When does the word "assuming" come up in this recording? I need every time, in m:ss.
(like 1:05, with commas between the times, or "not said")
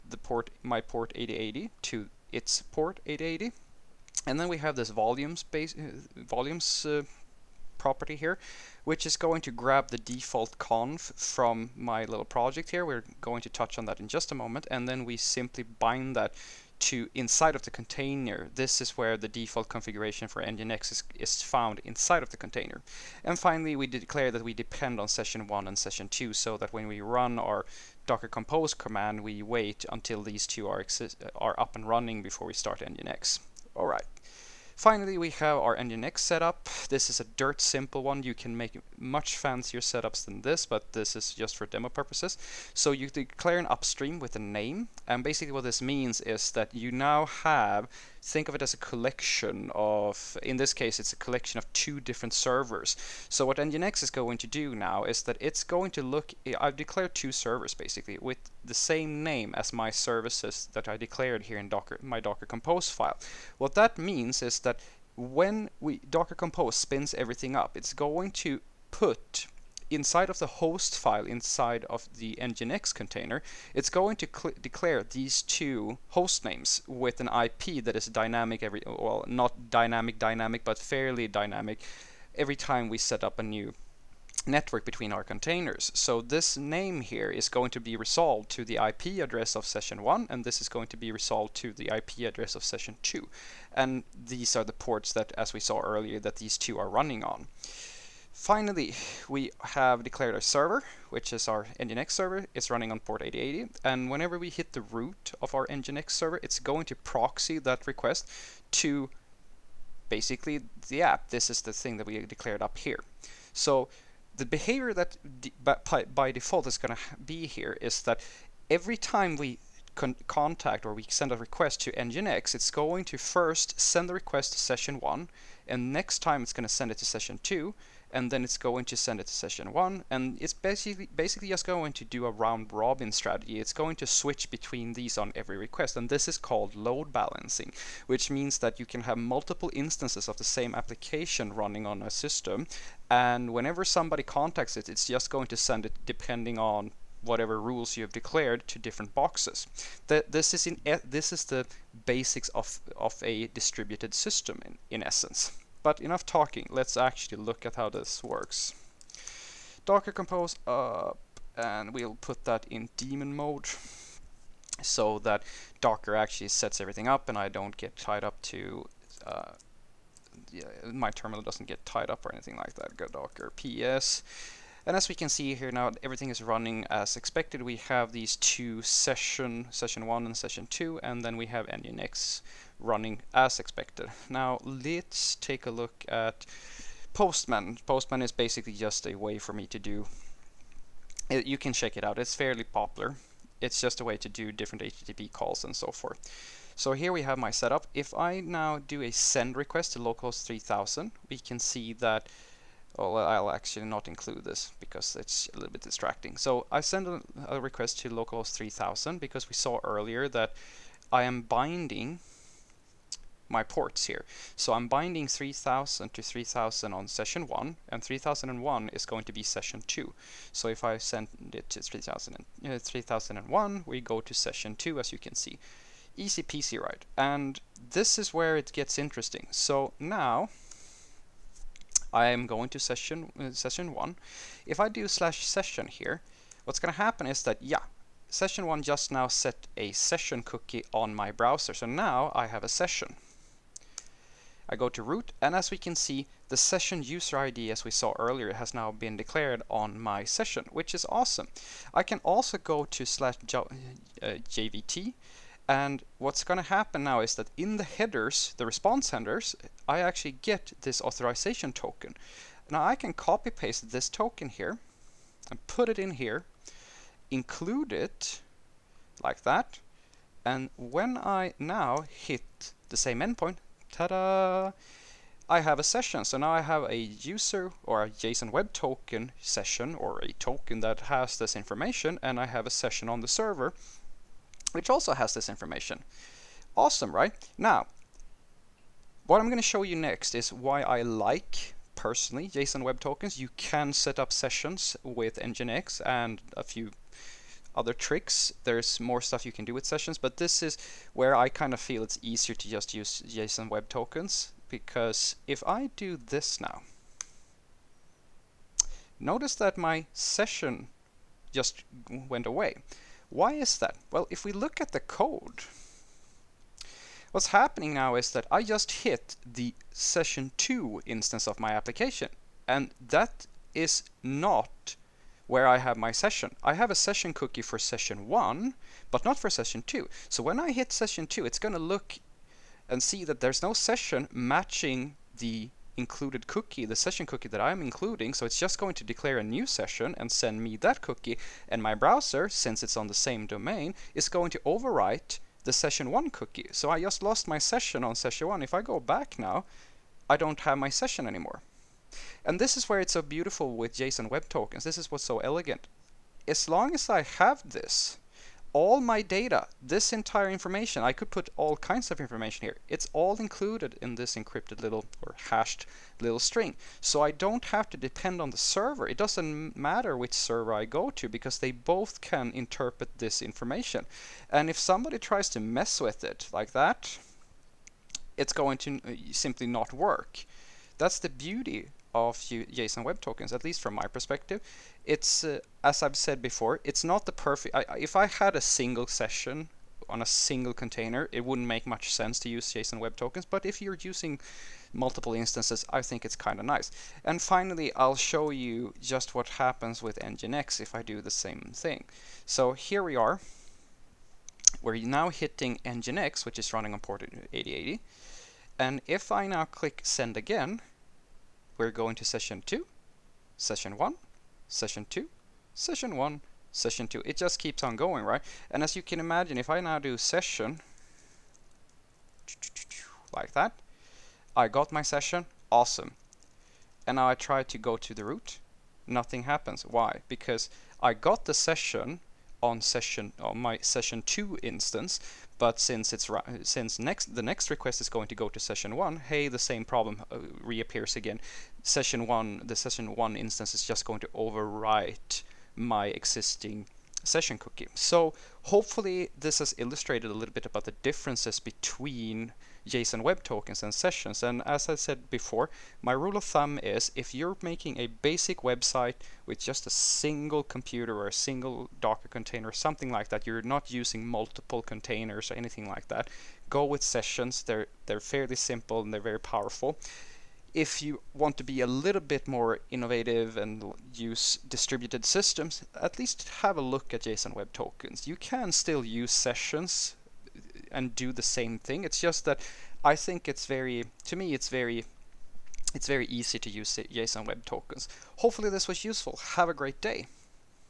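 not said.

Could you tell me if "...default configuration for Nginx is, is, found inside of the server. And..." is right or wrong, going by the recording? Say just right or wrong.
wrong.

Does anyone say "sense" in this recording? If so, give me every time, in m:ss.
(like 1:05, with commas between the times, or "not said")
6:32.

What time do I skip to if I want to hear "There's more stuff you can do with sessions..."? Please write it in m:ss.
4:58.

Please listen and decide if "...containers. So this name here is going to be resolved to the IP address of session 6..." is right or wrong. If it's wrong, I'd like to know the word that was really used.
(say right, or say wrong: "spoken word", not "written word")
wrong: "1", not "6".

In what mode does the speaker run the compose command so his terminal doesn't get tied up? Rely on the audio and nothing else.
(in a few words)
daemon mode.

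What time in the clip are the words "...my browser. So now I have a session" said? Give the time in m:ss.
4:01.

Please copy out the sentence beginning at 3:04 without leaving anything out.
Now let's take a look at Postman.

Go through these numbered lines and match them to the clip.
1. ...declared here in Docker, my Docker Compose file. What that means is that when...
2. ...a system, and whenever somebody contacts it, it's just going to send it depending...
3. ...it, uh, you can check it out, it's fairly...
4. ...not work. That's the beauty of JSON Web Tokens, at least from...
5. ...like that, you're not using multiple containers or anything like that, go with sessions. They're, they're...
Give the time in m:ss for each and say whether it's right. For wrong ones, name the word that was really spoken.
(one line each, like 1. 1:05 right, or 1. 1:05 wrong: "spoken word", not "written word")
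1. 1:00 right
2. 2:22 right
3. 3:11 right
4. 6:19 right
5. 7:43 right.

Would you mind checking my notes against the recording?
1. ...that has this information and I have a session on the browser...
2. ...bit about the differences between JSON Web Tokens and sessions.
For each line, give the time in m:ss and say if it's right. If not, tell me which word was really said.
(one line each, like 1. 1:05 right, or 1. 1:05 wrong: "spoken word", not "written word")
1. 4:40 wrong: "server", not "browser"
2. 7:30 right.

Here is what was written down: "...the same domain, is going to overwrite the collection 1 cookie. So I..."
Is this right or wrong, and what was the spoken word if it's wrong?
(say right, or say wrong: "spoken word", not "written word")
wrong: "session", not "collection".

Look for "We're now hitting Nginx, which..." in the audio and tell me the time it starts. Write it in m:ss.
6:44.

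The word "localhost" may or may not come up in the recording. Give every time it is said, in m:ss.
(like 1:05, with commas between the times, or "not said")
3:19, 3:28.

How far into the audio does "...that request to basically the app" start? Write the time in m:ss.
1:47.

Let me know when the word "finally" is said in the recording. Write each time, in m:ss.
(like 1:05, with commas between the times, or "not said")
0:23, 0:34, 1:38, 6:37.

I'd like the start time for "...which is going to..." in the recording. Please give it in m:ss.
0:08.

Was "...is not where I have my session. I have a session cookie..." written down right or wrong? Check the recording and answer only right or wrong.
right.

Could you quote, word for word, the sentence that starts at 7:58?
You can still use sessions and do the same thing.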